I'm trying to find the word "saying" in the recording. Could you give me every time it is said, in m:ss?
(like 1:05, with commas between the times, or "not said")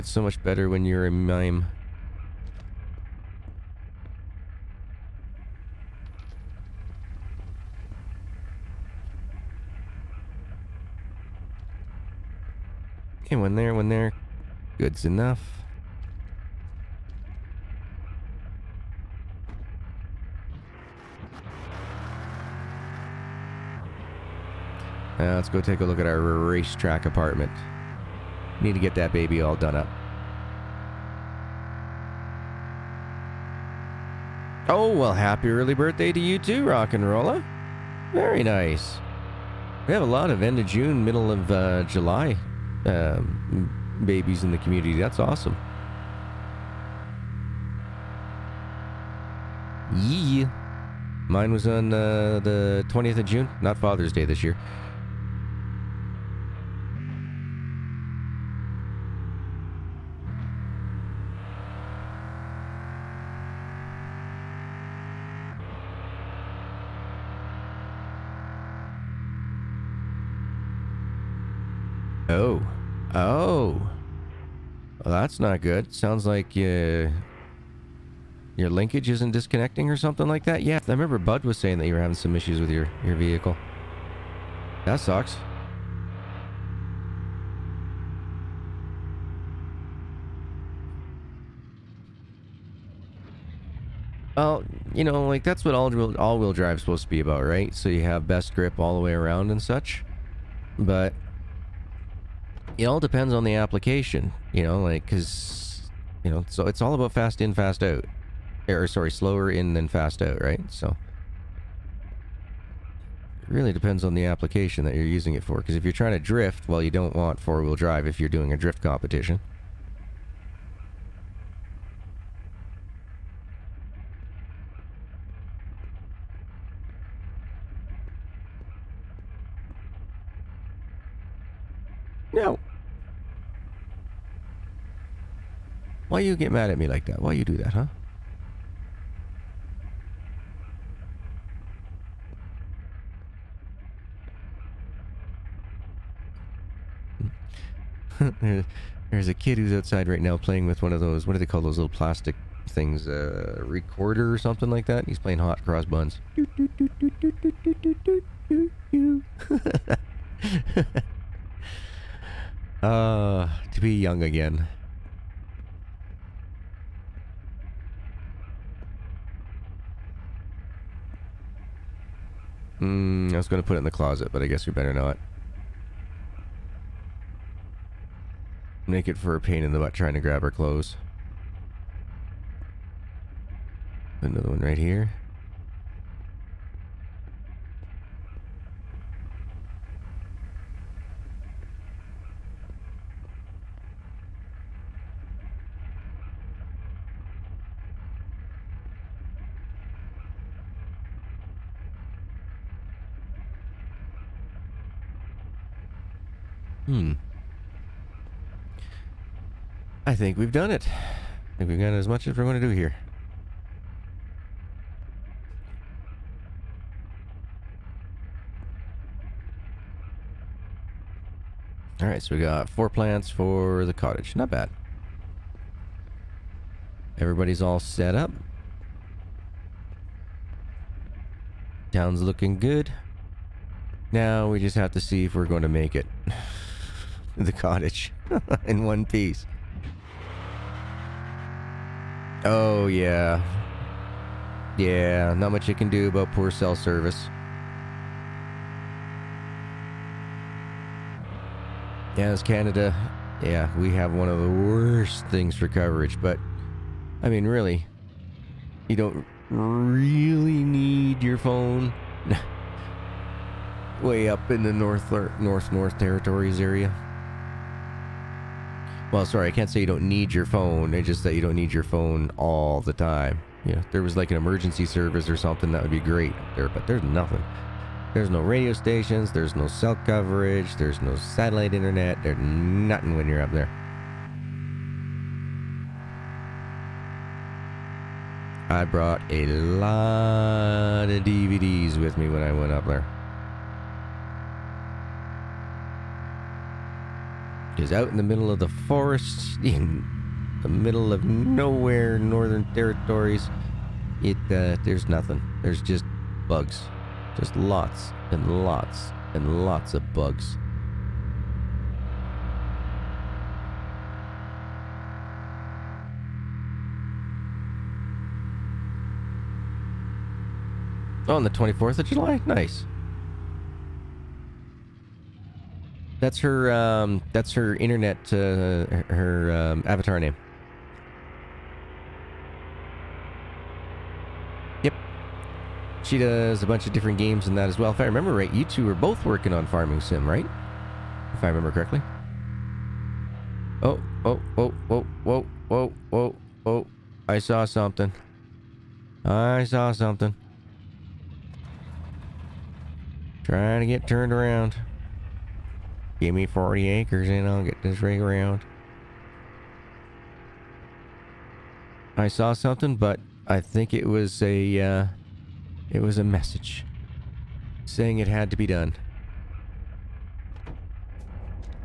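1:21, 6:07.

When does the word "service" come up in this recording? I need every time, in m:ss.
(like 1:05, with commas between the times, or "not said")
4:06, 4:34.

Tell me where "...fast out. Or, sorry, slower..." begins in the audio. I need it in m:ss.
1:47.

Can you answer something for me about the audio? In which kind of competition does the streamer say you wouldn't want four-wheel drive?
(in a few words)
Drift competition.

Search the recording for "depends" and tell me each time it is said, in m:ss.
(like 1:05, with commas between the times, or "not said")
1:42, 1:53.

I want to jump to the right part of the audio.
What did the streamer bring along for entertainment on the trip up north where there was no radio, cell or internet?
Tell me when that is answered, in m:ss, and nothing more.
4:51.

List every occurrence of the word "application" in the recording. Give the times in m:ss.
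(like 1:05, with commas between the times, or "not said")
1:43, 1:54.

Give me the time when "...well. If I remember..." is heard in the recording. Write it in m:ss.
5:37.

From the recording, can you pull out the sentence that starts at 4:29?
Well, sorry, I can't say you don't need your phone.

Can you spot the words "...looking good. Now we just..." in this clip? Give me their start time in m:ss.
3:52.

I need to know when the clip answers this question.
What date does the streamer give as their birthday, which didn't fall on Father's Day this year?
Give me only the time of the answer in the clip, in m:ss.
0:52.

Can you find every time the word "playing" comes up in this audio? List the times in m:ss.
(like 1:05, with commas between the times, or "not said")
2:30, 2:35.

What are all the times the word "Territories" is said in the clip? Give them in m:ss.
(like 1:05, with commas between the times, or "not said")
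4:25, 5:02.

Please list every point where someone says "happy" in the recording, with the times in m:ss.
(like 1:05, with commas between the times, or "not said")
0:35.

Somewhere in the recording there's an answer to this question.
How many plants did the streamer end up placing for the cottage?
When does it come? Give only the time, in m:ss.
3:42.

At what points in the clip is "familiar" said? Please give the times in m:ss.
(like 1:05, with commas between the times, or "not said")
not said.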